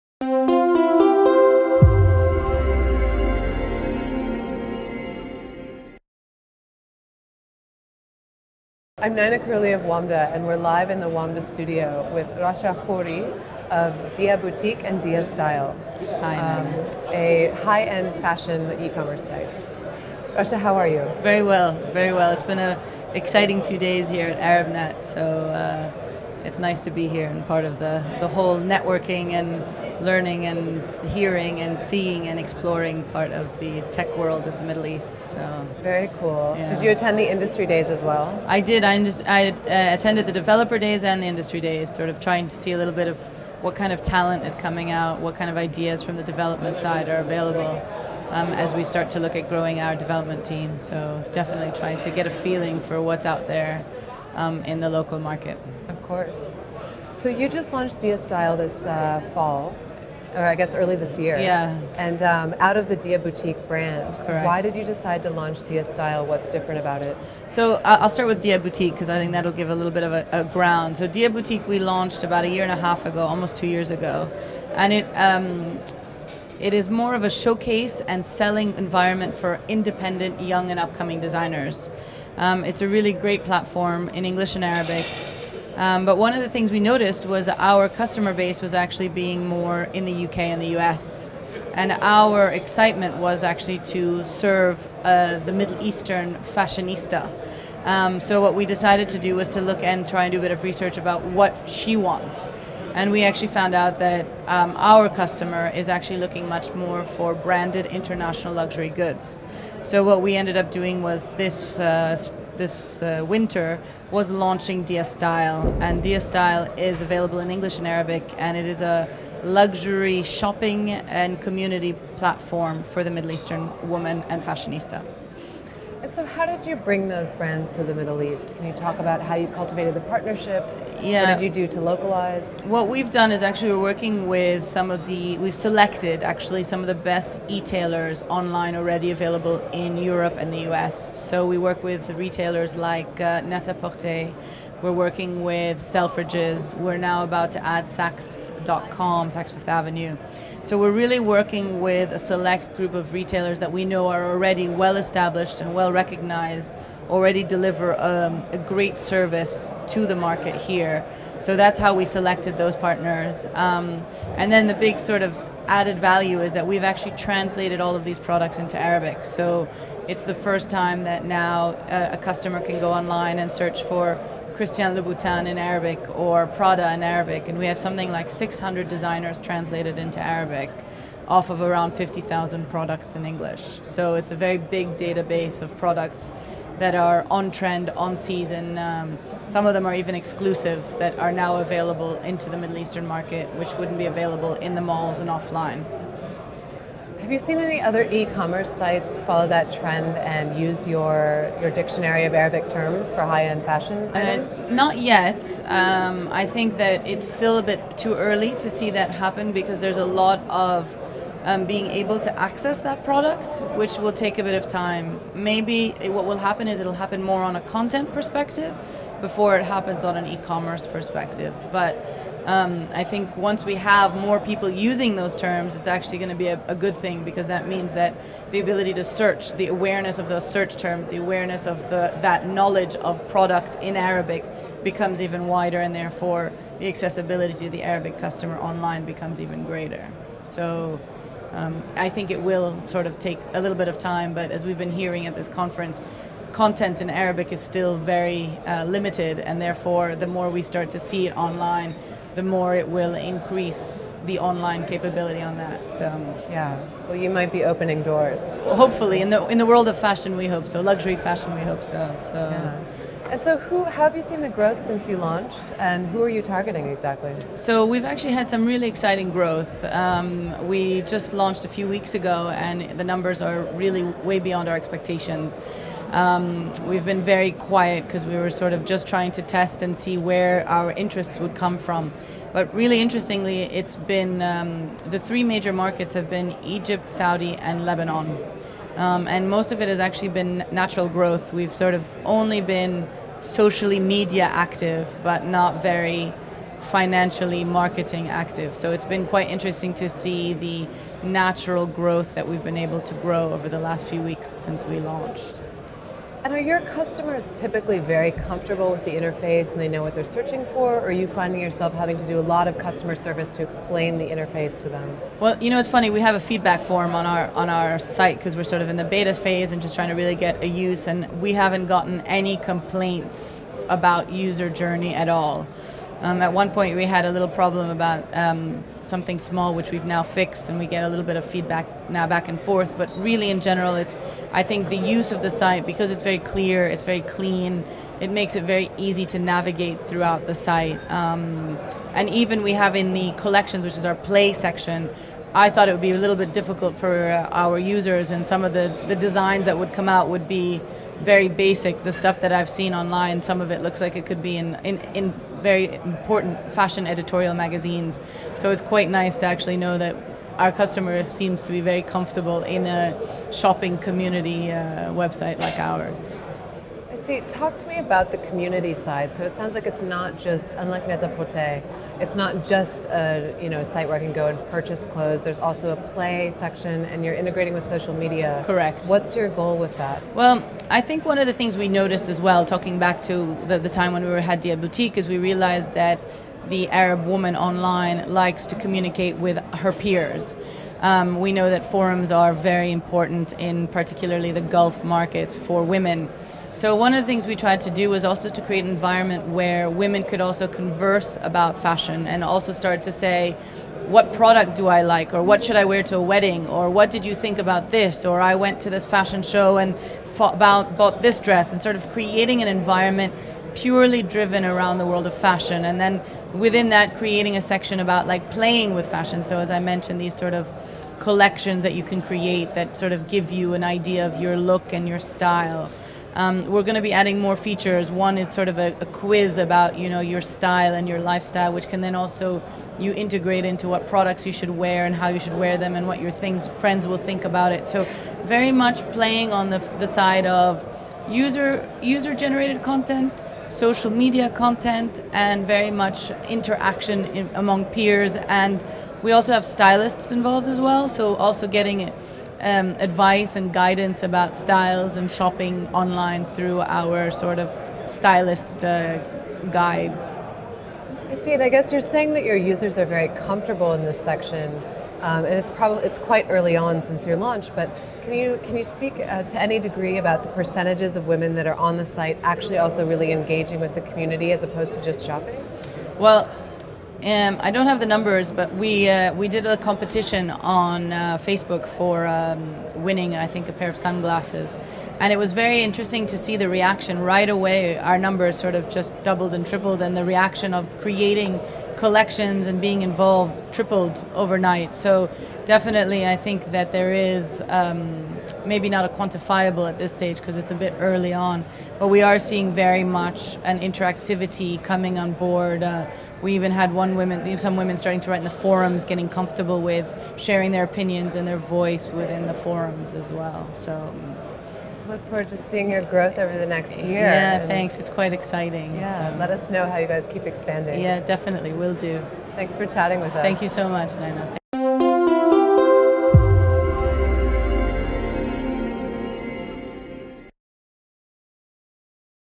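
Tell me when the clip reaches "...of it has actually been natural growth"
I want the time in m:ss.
4:49.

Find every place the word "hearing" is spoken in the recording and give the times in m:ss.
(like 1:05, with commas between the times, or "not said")
0:31, 4:04.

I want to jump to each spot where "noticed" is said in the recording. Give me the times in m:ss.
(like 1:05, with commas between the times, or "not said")
1:26, 6:21.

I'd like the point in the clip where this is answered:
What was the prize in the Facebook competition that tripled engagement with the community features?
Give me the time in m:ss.
8:03.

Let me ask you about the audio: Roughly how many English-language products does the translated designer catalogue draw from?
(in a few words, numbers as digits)
50,000.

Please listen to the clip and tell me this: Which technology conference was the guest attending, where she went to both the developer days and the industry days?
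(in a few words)
ArabNet.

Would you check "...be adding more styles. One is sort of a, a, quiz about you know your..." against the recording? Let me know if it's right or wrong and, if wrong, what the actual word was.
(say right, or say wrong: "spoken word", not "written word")
wrong: "features", not "styles".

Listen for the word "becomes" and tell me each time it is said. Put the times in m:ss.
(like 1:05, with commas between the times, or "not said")
3:54, 3:59.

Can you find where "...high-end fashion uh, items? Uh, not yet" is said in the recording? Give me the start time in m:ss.
3:23.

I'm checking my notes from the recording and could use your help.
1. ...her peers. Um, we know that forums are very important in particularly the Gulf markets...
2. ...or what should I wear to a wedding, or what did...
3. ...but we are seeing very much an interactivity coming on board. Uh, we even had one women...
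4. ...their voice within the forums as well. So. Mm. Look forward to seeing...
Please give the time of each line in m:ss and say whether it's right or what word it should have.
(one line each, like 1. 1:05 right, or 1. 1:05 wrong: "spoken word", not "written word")
1. 6:29 right
2. 6:45 right
3. 8:21 right
4. 8:31 right.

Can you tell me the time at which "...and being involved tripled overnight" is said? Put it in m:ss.
8:12.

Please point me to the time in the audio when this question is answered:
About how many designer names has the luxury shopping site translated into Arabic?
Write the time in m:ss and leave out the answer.
2:58.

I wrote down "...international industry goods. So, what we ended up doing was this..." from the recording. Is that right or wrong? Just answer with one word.
wrong.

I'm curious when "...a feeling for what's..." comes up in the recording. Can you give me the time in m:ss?
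0:52.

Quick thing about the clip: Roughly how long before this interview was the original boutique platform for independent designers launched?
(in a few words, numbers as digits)
A year and a half ago.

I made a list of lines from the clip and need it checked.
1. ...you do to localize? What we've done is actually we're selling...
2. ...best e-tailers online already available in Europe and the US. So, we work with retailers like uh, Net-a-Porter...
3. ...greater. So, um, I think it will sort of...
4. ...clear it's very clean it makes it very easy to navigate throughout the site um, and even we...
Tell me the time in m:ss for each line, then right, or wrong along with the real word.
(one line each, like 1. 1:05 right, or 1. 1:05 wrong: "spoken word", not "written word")
1. 2:11 wrong: "working", not "selling"
2. 2:16 right
3. 3:59 right
4. 5:36 right.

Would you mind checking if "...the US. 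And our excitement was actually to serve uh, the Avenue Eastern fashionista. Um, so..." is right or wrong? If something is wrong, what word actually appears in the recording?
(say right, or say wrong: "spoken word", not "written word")
wrong: "Middle", not "Avenue".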